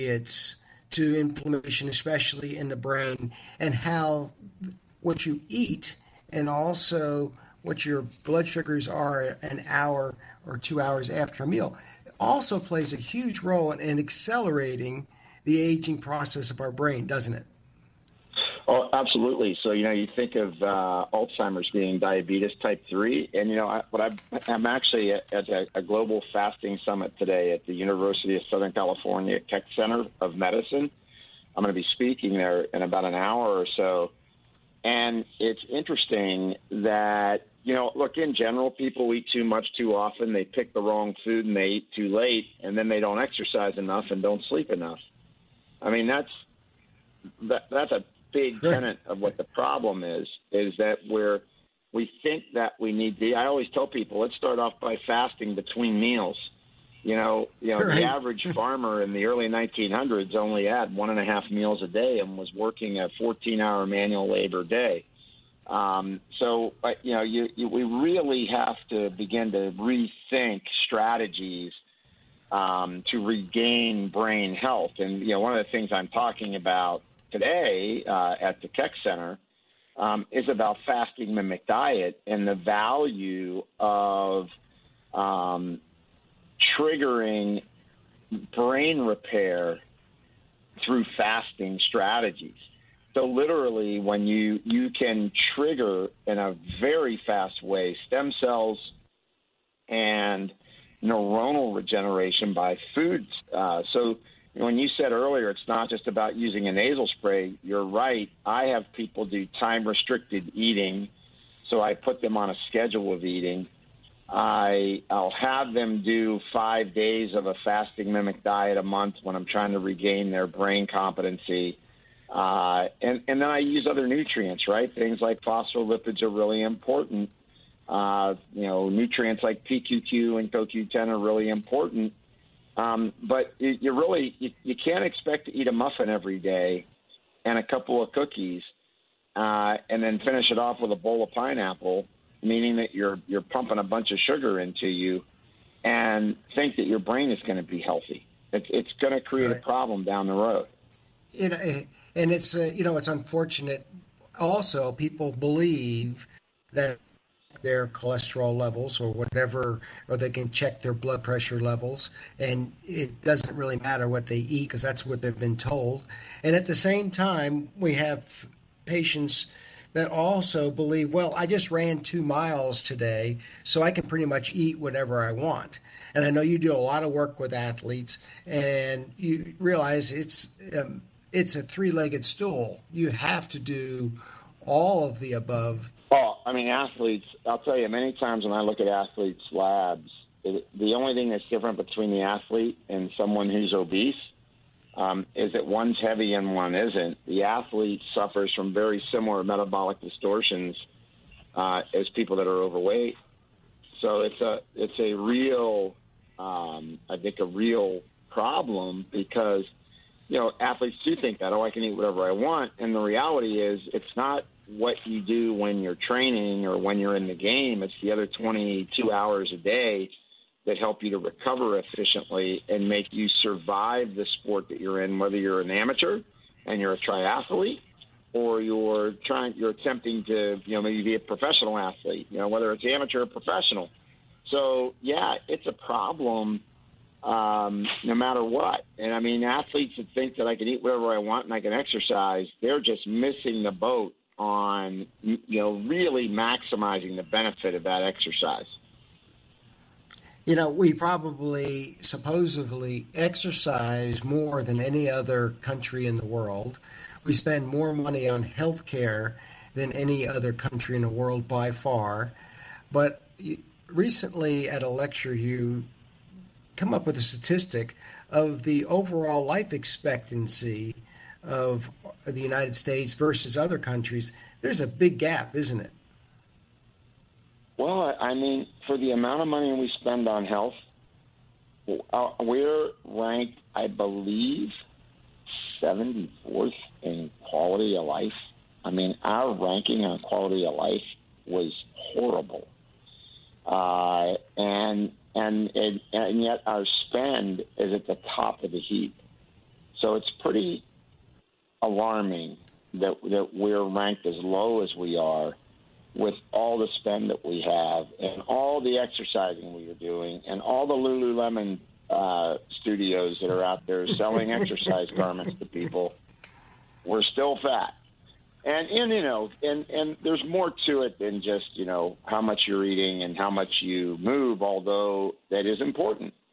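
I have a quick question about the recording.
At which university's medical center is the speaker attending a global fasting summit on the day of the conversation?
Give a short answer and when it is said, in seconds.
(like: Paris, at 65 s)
University of Southern California, at 27 s.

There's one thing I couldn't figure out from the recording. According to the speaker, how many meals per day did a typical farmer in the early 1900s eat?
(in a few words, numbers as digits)
1.5.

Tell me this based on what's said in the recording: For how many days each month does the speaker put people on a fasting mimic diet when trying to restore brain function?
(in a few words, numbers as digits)
5.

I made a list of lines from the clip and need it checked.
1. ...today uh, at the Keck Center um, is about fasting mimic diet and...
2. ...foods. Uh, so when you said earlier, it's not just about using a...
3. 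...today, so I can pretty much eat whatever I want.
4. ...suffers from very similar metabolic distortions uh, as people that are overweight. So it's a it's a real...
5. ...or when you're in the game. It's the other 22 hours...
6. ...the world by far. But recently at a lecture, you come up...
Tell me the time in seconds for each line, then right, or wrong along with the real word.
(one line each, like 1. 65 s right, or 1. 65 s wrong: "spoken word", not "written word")
1. 77 s right
2. 102 s right
3. 172 s right
4. 198 s right
5. 216 s right
6. 261 s right.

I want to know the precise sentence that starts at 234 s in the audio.
So yeah, it's a problem um, no matter what.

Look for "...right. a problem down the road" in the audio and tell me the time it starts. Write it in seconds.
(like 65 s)
149 s.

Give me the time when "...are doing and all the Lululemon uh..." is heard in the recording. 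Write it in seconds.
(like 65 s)
309 s.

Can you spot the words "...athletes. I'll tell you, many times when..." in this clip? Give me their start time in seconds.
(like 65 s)
186 s.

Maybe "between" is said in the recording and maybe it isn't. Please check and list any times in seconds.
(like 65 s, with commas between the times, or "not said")
55 s, 191 s.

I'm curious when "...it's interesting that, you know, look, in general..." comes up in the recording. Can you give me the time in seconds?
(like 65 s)
35 s.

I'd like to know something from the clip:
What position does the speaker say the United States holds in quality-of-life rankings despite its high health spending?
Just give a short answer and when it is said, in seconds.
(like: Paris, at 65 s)
74th, at 285 s.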